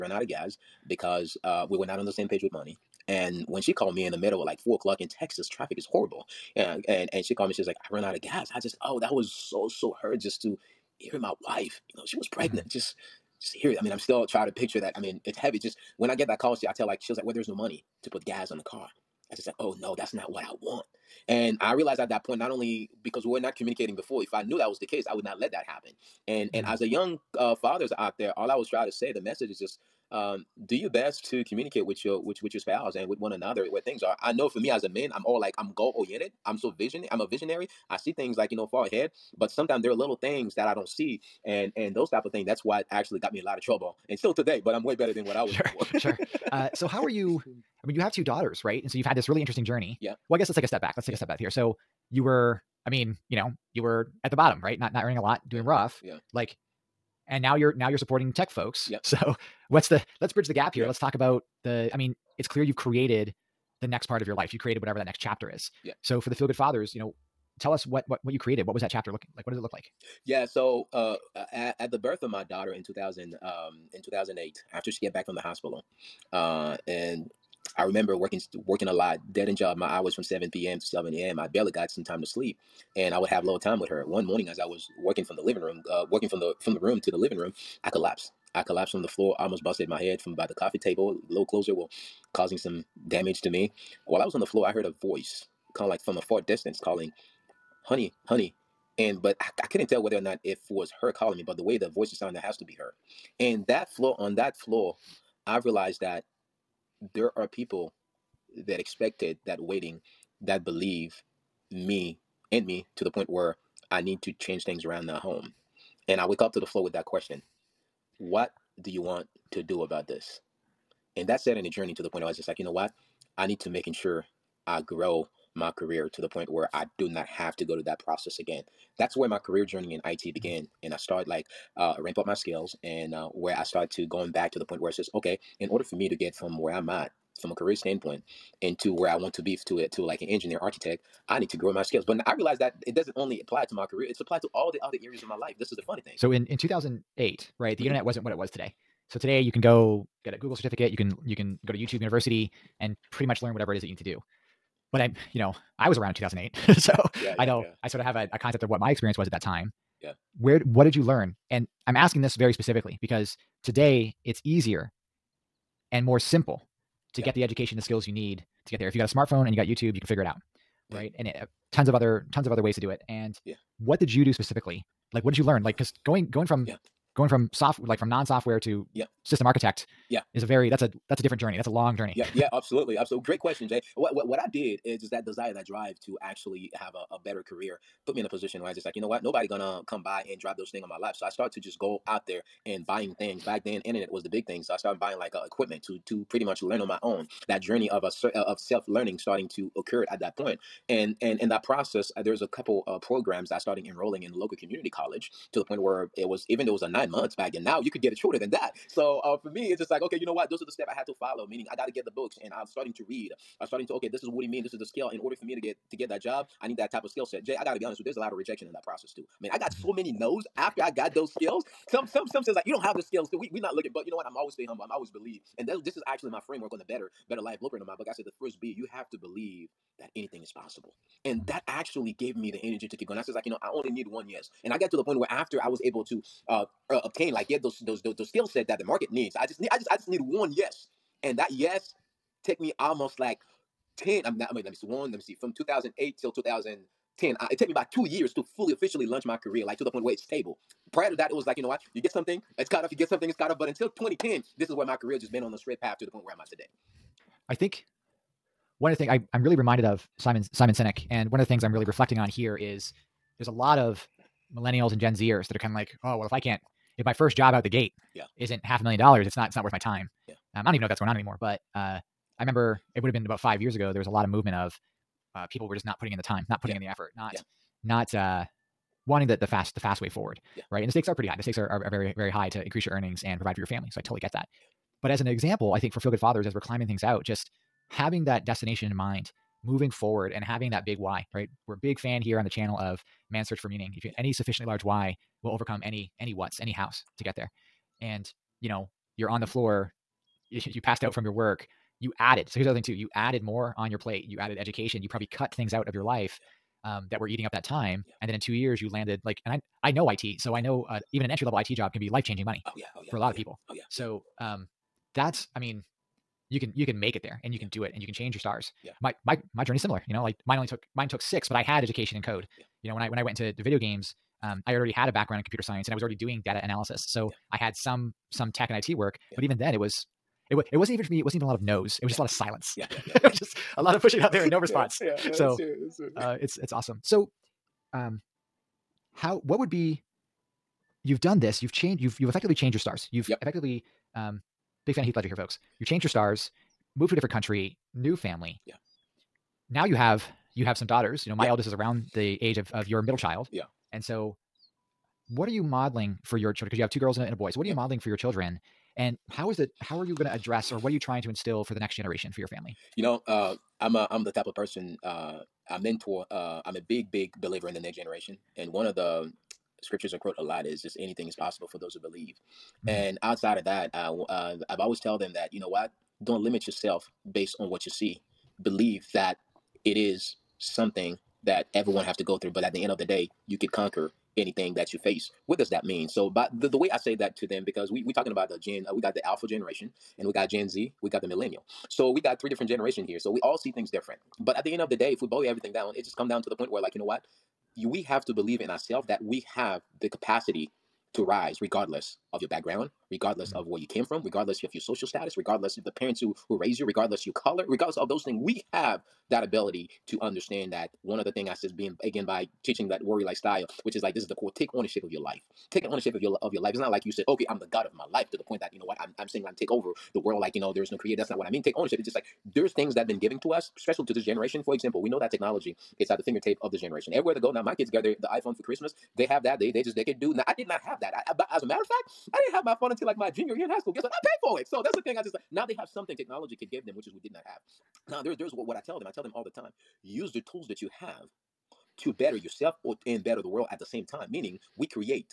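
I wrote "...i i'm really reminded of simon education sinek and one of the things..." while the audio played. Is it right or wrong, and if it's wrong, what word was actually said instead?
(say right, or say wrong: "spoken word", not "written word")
wrong: "simon", not "education".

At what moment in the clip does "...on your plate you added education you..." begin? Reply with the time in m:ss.
5:03.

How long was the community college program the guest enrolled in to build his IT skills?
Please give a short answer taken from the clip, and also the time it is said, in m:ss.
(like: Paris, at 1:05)
9 months, at 3:26.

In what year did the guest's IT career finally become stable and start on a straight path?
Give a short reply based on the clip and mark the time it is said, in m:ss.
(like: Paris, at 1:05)
2010, at 4:14.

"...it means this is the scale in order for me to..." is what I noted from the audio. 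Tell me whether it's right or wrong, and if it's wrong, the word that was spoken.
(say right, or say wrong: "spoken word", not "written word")
right.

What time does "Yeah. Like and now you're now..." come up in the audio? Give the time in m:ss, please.
0:56.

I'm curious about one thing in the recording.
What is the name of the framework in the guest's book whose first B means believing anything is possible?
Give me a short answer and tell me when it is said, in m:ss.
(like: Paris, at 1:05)
Better Life Blueprint, at 3:46.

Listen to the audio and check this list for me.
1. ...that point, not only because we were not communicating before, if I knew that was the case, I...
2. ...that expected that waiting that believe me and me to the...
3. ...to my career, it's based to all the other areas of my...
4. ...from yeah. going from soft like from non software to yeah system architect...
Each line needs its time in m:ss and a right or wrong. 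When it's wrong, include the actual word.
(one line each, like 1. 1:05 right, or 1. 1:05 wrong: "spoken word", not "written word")
1. 0:22 right
2. 1:48 right
3. 2:23 wrong: "applied", not "based"
4. 2:56 right.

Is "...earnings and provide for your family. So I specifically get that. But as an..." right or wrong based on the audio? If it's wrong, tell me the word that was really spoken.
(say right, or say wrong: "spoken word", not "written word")
wrong: "totally", not "specifically".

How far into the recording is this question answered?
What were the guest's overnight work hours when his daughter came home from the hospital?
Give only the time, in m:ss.
1:20.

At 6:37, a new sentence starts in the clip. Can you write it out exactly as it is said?
You, we have to believe in ourselves that we have the capacity to rise regardless of your background, regardless mm-hmm.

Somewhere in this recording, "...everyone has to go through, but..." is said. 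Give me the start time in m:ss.
6:21.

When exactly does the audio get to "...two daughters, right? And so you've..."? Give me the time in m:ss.
0:48.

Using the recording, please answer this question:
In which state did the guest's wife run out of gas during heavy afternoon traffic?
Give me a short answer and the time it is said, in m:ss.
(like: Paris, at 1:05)
Texas, at 0:05.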